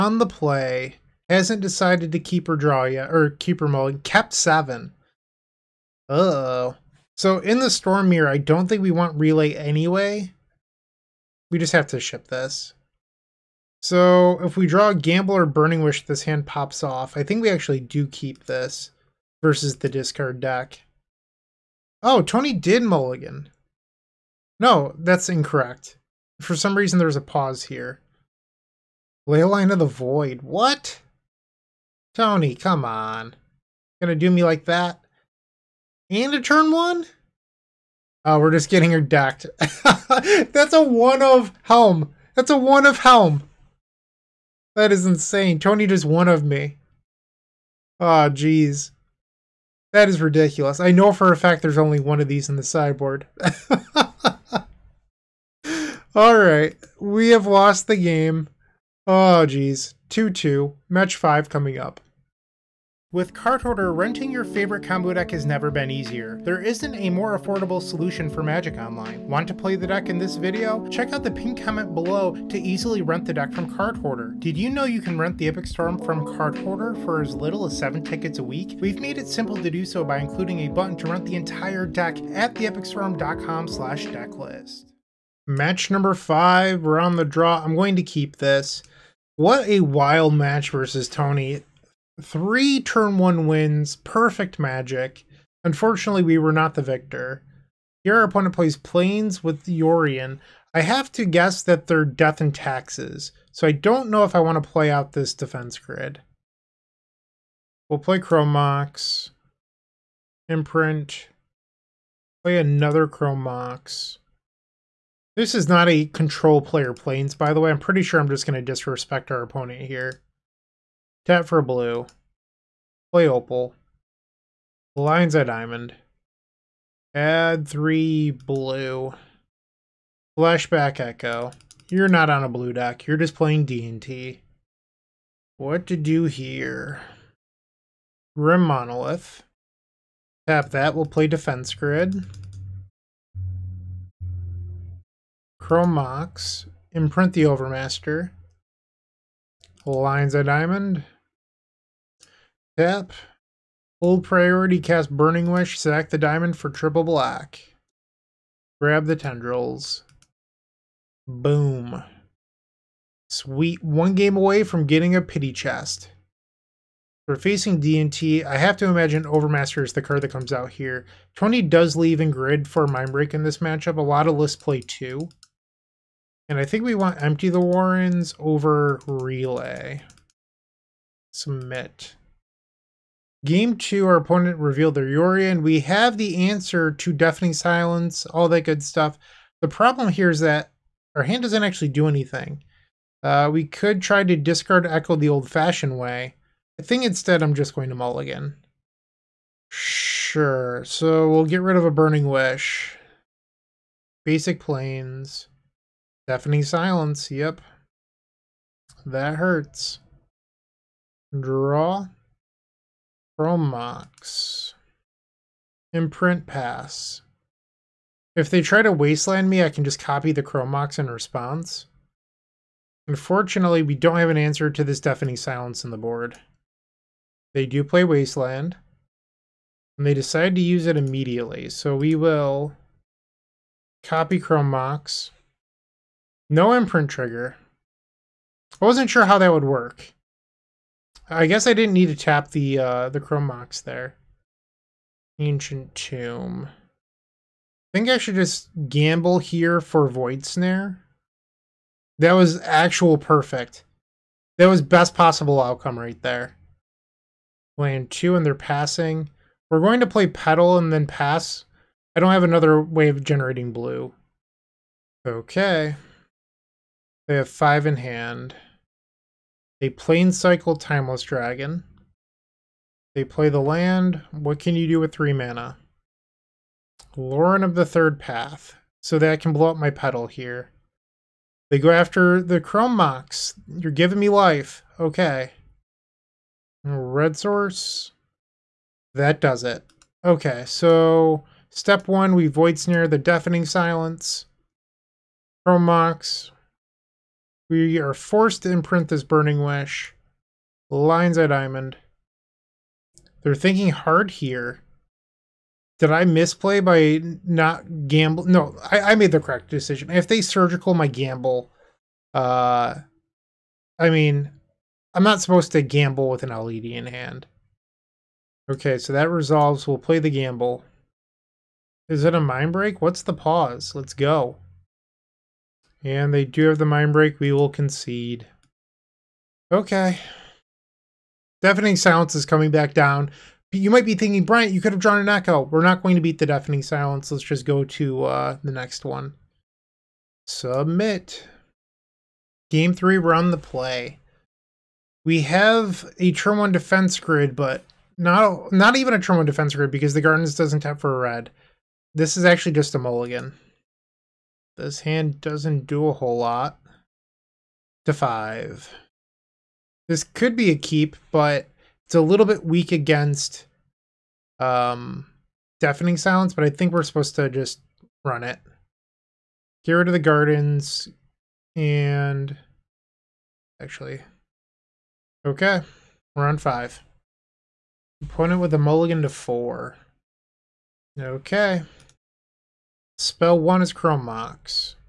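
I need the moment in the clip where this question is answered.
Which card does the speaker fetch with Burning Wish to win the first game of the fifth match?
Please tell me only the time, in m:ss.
2:39.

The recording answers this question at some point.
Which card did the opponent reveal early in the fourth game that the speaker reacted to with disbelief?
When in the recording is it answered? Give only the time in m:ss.
0:29.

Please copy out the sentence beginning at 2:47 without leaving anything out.
For facing DNT, I have to imagine Overmaster is the card that comes out here.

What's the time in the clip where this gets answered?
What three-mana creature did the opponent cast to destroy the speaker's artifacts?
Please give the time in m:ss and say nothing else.
4:37.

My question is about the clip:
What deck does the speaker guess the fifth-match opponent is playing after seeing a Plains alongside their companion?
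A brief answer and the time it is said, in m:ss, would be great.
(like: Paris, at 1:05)
Death and Taxes, at 1:42.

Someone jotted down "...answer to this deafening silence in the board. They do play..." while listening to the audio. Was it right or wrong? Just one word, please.
right.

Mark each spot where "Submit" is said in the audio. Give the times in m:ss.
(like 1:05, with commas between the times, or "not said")
3:01, 5:40.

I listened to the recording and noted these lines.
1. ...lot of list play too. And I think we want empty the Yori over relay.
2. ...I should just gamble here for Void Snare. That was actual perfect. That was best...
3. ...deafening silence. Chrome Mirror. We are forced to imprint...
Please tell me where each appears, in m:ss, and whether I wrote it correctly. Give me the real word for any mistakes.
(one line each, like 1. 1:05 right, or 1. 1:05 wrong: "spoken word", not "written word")
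1. 2:54 wrong: "Warrens", not "Yori"
2. 4:08 right
3. 4:53 wrong: "Mox", not "Mirror".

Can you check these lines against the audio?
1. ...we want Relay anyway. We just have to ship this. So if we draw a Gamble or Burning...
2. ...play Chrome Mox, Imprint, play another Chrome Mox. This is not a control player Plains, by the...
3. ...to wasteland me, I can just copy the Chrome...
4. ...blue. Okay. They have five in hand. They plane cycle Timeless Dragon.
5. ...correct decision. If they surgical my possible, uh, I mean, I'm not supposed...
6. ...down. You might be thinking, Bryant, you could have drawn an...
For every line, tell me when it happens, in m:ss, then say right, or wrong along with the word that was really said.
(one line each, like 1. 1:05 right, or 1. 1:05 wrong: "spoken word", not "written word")
1. 0:08 right
2. 1:47 right
3. 3:38 right
4. 4:23 right
5. 5:09 wrong: "gamble", not "possible"
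6. 5:32 right.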